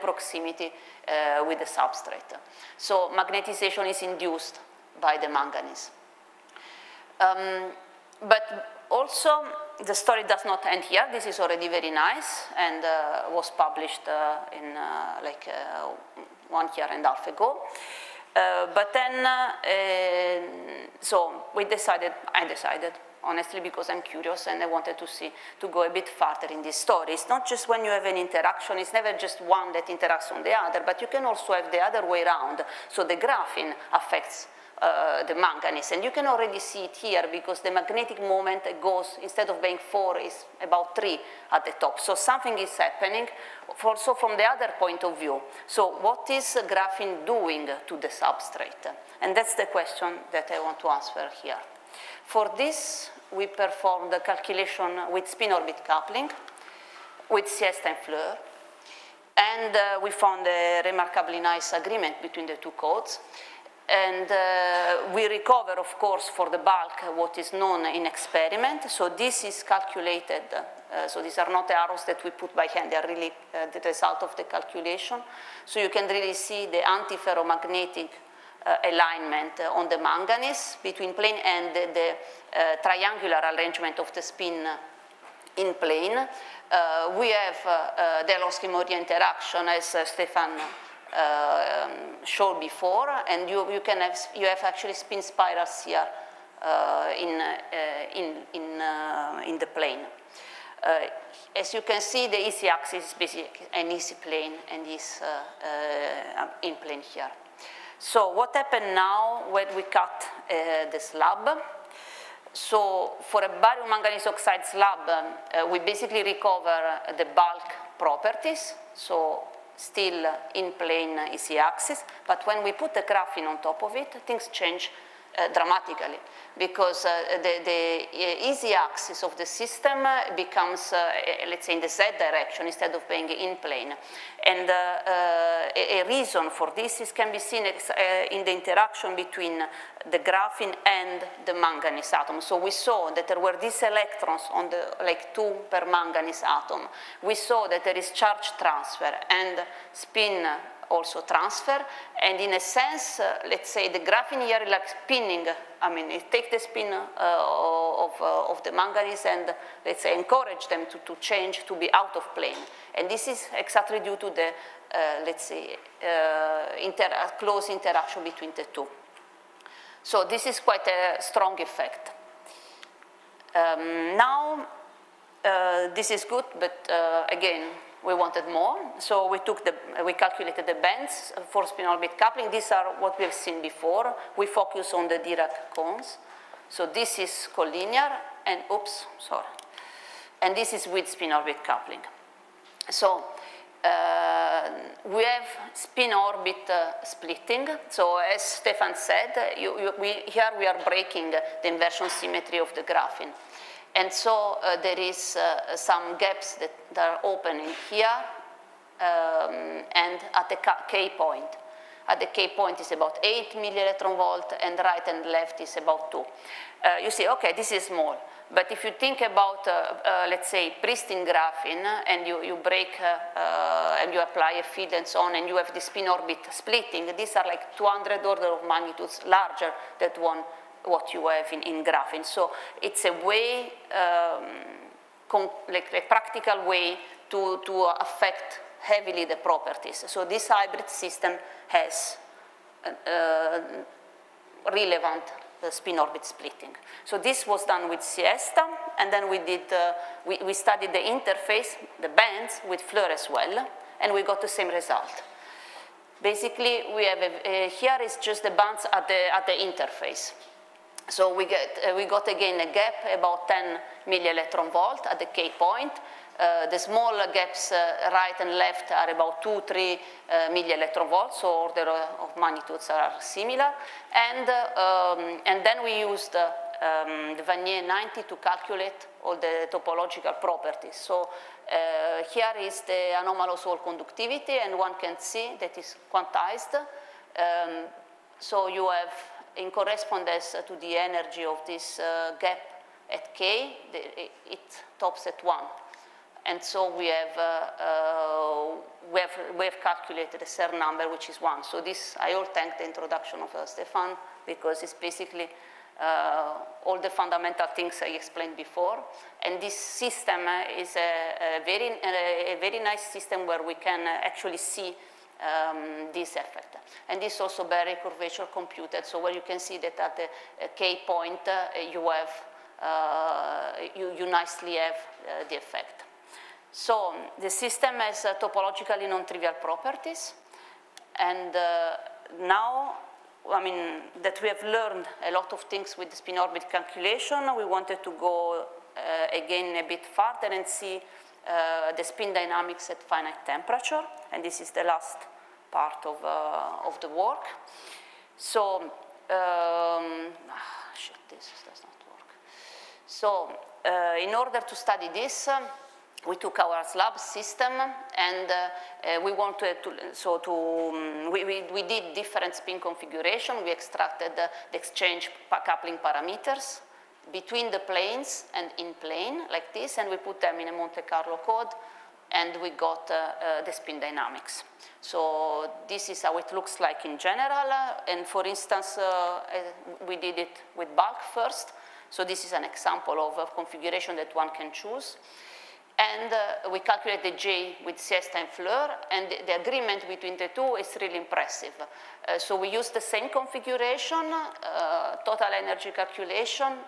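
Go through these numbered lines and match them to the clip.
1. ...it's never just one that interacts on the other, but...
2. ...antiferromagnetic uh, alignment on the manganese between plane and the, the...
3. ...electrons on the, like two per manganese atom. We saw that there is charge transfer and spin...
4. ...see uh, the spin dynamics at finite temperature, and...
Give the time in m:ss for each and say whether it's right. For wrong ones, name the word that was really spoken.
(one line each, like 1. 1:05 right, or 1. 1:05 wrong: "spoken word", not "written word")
1. 0:28 right
2. 1:16 right
3. 2:23 right
4. 5:40 right.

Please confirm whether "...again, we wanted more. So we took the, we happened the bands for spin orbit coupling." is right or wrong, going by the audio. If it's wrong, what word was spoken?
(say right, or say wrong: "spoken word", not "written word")
wrong: "calculated", not "happened".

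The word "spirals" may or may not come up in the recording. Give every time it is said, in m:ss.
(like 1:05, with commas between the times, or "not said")
1:35.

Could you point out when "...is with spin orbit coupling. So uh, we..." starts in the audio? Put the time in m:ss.
3:10.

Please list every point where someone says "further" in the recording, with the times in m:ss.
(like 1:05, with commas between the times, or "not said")
0:26, 5:40.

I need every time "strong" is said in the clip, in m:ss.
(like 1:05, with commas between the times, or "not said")
2:51.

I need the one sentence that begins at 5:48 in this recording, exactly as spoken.
So, um, ah, shit, this does not work.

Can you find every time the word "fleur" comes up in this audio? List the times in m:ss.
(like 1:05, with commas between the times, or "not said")
0:58, 4:12, 6:28.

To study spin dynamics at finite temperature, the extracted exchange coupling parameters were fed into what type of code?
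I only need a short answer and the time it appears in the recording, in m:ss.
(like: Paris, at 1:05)
Monte Carlo, at 6:10.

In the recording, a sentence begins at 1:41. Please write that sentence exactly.
as you can see, the easy axis is basically an easy plane and is in plane here.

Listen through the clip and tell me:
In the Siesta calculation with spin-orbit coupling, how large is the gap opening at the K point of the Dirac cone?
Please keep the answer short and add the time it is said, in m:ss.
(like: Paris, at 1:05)
8 meV, at 3:33.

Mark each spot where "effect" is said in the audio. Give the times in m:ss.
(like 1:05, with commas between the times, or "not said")
2:51, 5:16, 5:25.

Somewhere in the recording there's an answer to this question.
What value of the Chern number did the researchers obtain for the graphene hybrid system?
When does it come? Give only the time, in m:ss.
5:00.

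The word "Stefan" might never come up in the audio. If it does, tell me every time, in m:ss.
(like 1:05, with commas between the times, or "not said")
1:30, 3:18, 5:03.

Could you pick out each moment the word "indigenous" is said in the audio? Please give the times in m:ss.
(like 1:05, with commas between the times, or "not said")
not said.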